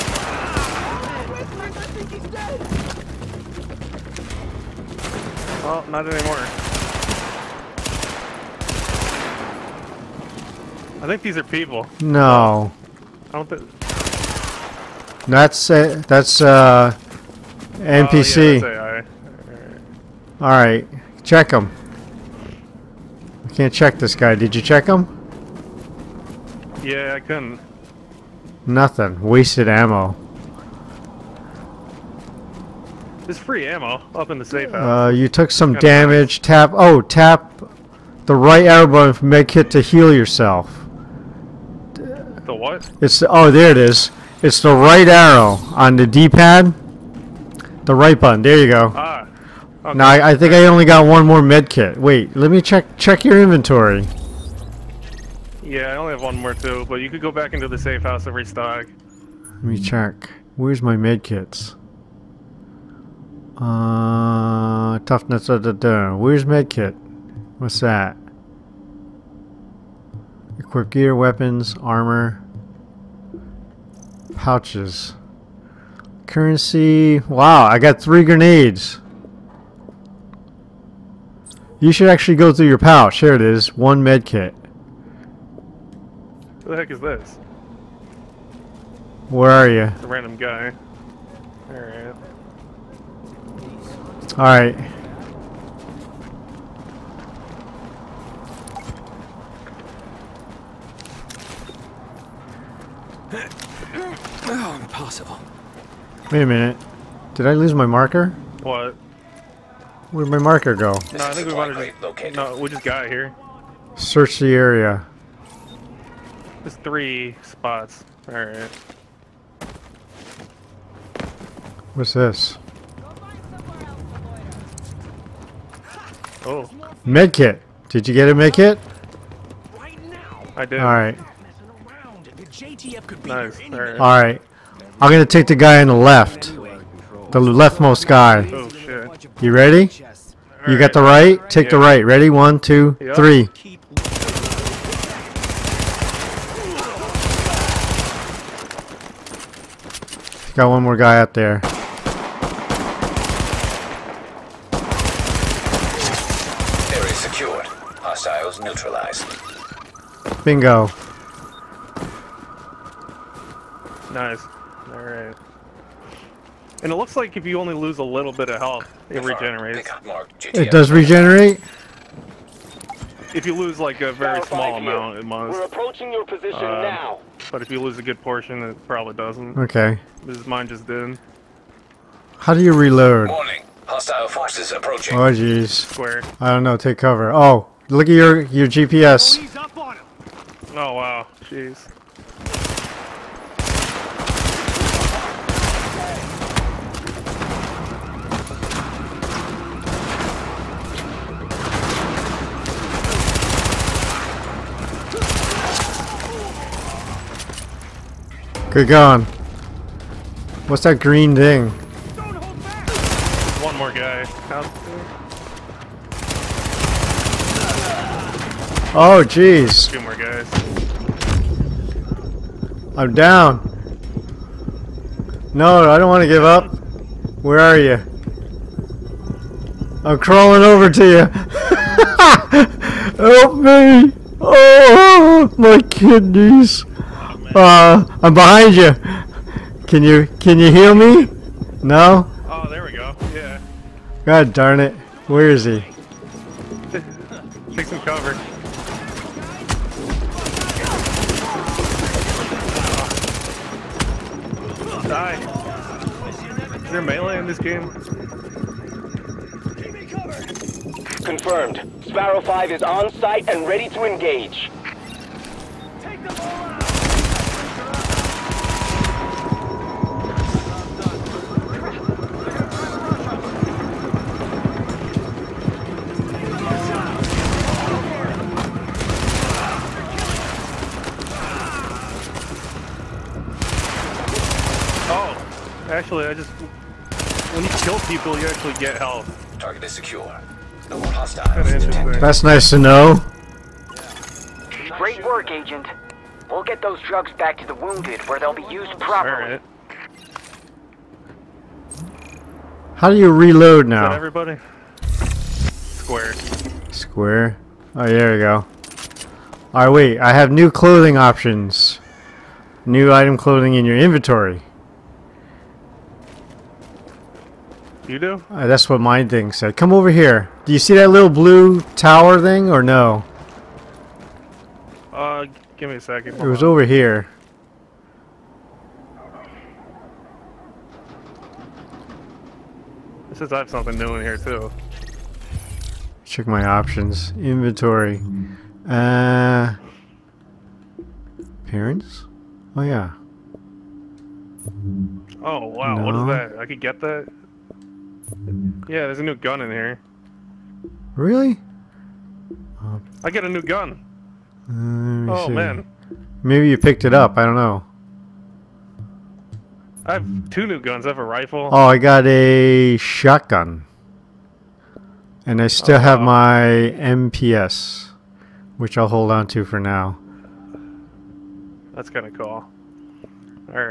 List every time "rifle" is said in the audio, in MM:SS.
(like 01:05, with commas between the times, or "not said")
06:01.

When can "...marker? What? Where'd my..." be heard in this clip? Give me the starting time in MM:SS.
01:47.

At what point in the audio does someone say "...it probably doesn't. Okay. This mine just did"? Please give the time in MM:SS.
02:58.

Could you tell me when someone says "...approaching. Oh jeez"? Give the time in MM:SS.
03:04.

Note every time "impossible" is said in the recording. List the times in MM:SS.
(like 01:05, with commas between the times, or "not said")
01:44.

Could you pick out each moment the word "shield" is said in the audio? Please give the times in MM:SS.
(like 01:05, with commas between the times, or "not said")
not said.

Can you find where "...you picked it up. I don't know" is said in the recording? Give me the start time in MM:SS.
05:56.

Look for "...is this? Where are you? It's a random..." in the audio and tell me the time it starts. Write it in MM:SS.
01:26.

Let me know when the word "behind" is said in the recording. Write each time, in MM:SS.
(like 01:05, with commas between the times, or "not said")
03:58.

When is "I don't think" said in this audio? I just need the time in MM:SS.
00:13.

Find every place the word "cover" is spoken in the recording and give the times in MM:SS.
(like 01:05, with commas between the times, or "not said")
03:06, 04:08.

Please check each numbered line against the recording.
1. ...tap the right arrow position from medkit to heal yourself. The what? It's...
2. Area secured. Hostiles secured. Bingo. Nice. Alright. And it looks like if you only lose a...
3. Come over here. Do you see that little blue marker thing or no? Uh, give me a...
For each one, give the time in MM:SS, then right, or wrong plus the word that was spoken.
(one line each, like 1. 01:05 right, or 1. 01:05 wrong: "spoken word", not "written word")
1. 00:36 wrong: "button", not "position"
2. 02:36 wrong: "neutralized", not "secured"
3. 05:19 wrong: "tower", not "marker".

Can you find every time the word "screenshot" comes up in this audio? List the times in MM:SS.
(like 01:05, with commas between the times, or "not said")
not said.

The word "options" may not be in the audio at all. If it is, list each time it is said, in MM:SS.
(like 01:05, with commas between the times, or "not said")
05:11, 05:36.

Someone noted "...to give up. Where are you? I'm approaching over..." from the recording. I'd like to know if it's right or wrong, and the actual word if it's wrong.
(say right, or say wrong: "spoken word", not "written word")
wrong: "crawling", not "approaching".